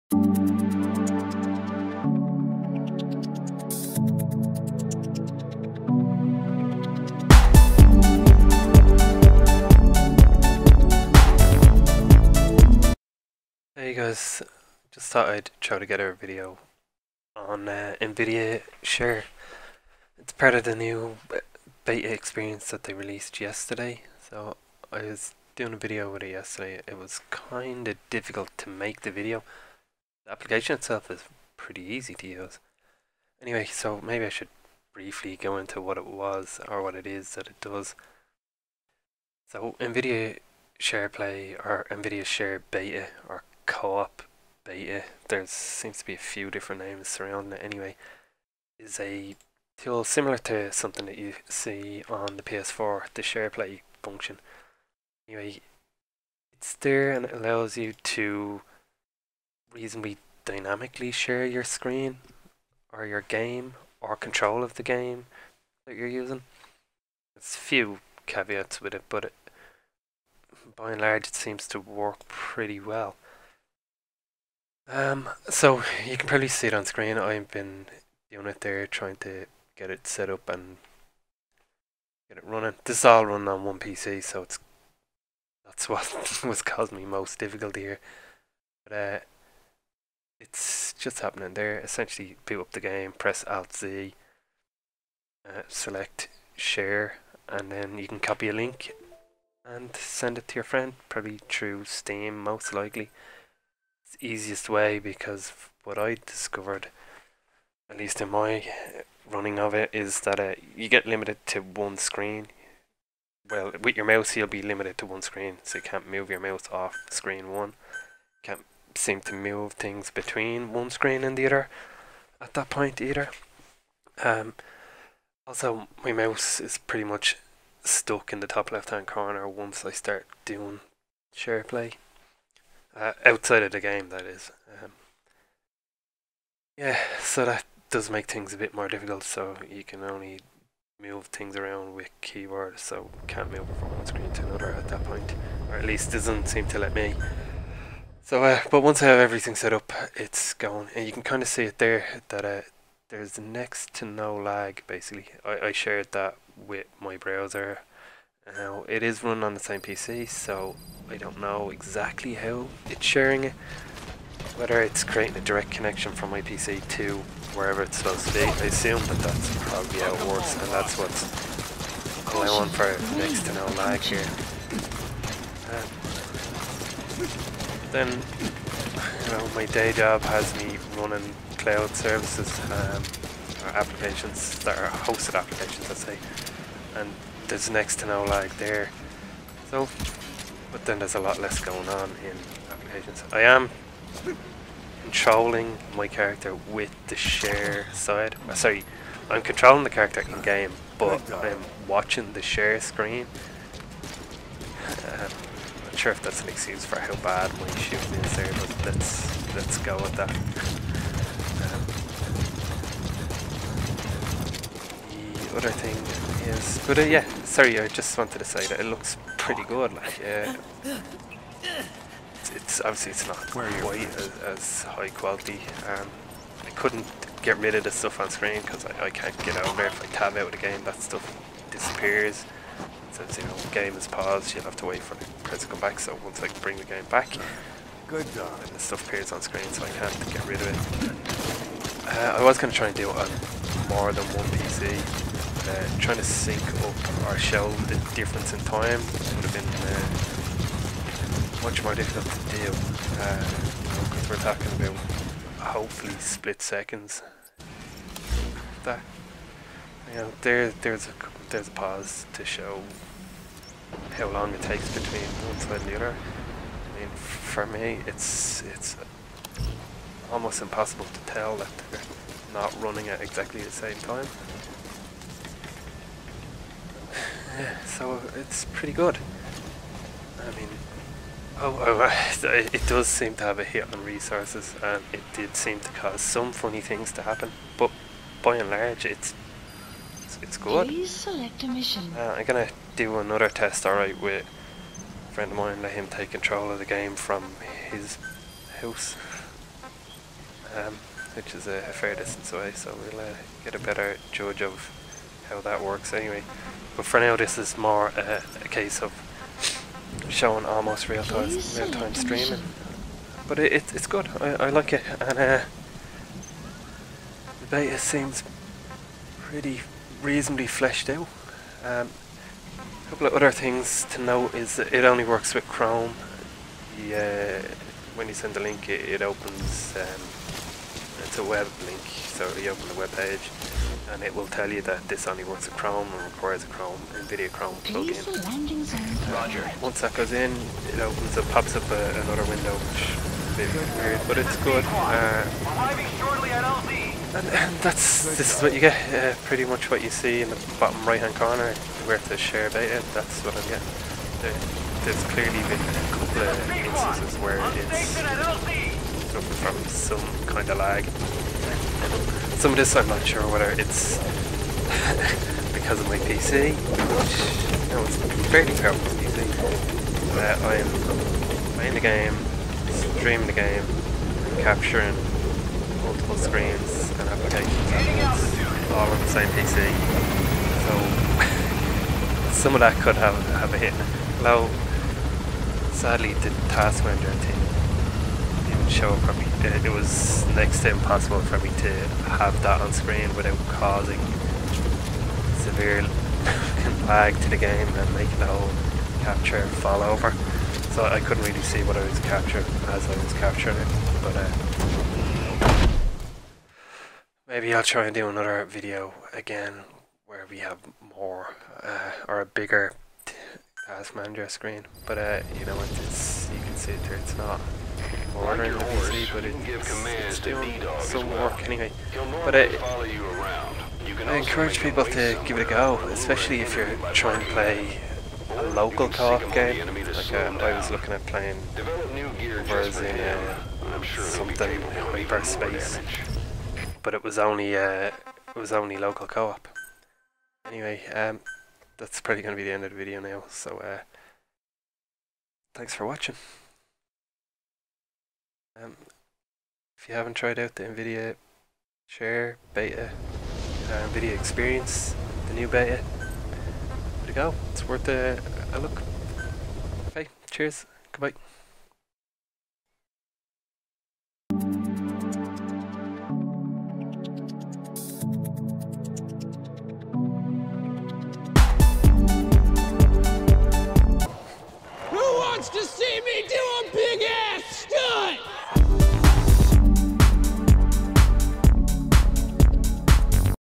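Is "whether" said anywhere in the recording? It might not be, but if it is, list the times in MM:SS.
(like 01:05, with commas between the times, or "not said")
02:44, 06:03.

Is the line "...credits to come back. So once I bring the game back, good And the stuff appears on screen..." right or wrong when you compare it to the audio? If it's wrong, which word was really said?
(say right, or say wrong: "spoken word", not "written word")
right.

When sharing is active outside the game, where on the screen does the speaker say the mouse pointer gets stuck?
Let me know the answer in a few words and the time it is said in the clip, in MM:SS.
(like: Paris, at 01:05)
top left hand corner, at 02:08.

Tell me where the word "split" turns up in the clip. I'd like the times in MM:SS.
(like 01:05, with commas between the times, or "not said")
04:16.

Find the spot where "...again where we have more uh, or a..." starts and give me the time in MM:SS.
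06:49.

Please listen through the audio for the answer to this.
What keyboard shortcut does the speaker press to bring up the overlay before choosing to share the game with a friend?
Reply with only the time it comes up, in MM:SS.
01:33.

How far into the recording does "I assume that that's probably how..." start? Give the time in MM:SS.
02:48.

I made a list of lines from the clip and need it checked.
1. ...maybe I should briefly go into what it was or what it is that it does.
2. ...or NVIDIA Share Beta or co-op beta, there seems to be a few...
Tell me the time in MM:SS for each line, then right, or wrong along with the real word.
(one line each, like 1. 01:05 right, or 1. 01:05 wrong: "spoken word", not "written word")
1. 00:34 right
2. 00:41 right.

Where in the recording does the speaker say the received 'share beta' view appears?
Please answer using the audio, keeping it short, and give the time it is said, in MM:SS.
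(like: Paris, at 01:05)
bottom right hand corner, at 05:50.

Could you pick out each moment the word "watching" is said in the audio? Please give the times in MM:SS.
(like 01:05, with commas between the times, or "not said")
03:21, 07:26.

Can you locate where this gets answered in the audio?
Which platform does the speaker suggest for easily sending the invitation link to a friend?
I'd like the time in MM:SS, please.
01:41.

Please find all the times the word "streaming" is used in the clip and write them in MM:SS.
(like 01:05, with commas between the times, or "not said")
05:12, 06:13.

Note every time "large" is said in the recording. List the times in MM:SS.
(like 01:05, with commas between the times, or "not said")
01:11, 04:48.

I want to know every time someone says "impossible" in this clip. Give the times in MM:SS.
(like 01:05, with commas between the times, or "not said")
04:30, 06:30.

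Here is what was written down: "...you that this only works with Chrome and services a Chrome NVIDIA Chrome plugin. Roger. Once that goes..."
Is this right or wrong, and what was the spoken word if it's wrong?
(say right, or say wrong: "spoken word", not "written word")
wrong: "requires", not "services".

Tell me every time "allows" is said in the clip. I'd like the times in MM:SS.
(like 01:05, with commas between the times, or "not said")
00:57.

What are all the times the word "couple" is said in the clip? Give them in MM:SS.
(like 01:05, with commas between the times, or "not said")
05:23, 05:56.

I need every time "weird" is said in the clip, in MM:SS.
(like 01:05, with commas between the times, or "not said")
05:44.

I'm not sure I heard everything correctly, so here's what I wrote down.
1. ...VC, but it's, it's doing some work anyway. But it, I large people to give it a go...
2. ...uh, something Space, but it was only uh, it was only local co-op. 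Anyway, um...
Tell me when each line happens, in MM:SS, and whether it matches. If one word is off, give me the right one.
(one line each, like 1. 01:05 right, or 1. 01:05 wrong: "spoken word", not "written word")
1. 06:58 wrong: "encourage", not "large"
2. 07:13 right.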